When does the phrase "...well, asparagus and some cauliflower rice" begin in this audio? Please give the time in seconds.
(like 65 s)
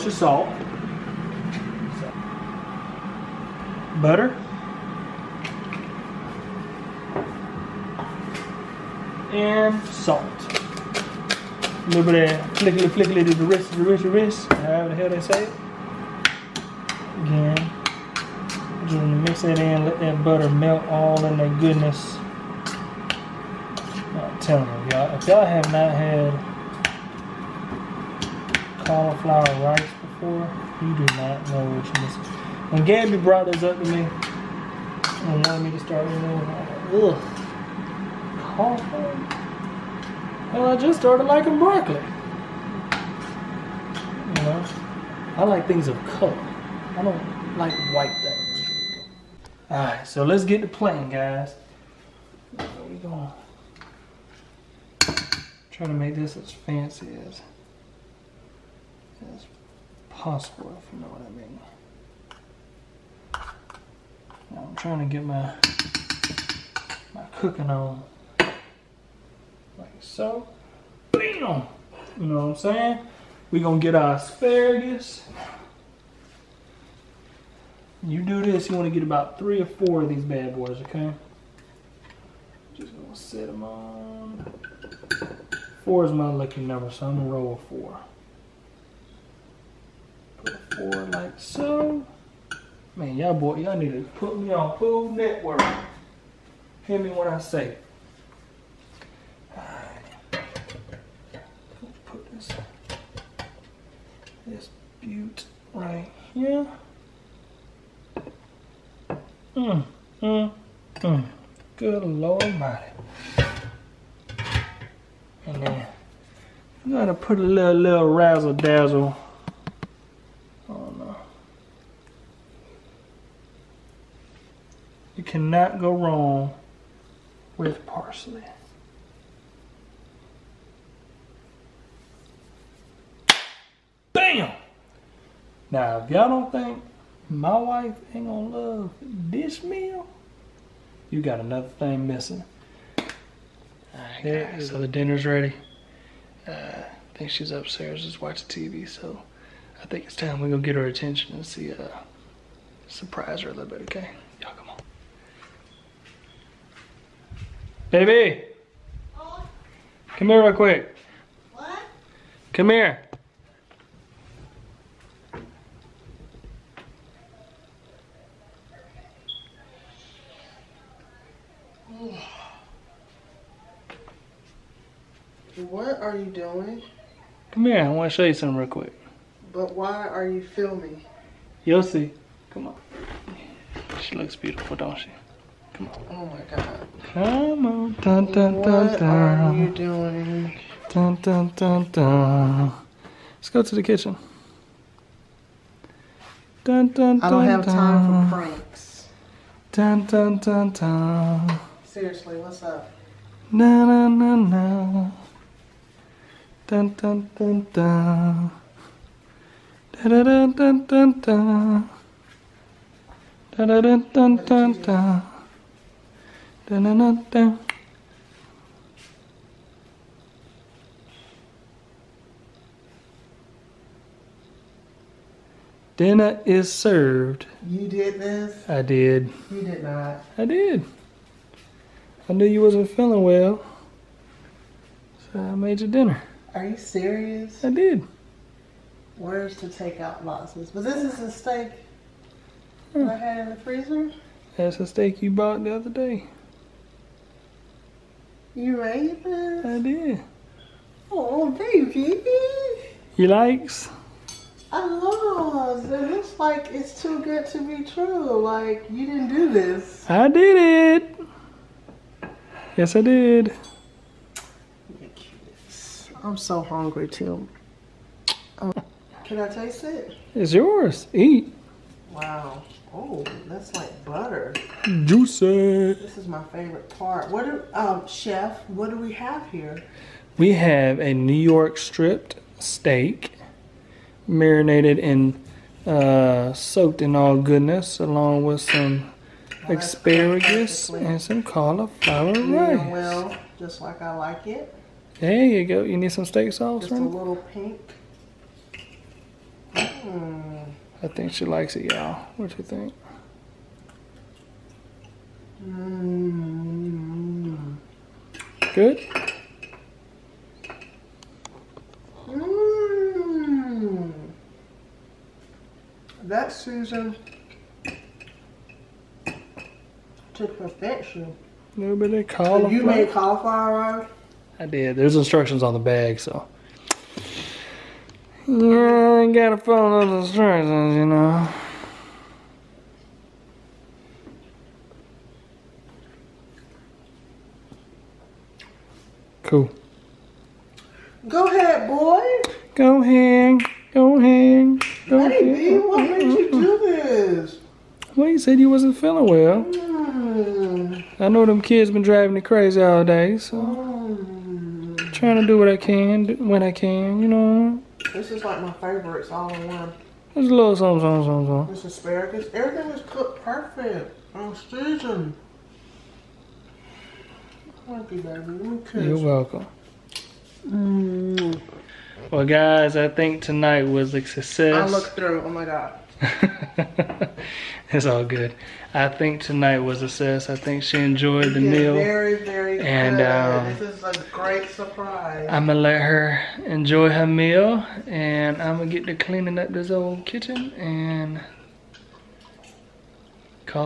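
289 s.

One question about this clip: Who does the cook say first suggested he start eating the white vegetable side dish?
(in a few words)
Gabby.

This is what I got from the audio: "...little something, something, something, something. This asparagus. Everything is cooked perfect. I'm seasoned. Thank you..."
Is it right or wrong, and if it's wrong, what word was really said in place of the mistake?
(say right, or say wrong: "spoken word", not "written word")
right.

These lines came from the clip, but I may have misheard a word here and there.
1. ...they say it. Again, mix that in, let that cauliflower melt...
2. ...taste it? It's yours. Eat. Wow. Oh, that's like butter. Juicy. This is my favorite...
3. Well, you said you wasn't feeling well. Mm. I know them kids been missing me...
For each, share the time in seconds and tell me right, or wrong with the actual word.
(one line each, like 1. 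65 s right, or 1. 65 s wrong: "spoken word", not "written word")
1. 15 s wrong: "butter", not "cauliflower"
2. 269 s right
3. 348 s wrong: "driving", not "missing".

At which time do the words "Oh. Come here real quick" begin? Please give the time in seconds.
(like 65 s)
159 s.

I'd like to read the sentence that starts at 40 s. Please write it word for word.
Well, I just started liking broccoli.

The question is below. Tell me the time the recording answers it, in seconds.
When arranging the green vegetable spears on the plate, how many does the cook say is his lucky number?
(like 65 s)
85 s.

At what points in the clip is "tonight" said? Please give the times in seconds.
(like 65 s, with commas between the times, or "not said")
373 s, 379 s.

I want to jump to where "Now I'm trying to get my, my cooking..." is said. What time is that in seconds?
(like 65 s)
64 s.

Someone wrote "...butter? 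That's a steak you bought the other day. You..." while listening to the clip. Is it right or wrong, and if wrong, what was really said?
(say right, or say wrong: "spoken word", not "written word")
wrong: "freezer", not "butter".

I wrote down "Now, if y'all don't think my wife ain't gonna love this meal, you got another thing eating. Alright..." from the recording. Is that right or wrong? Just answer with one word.
wrong.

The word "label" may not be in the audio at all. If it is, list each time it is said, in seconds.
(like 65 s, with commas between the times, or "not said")
not said.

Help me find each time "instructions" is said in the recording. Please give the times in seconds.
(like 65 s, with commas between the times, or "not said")
325 s, 330 s.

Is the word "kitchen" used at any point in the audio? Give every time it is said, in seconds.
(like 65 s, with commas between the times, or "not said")
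193 s, 390 s.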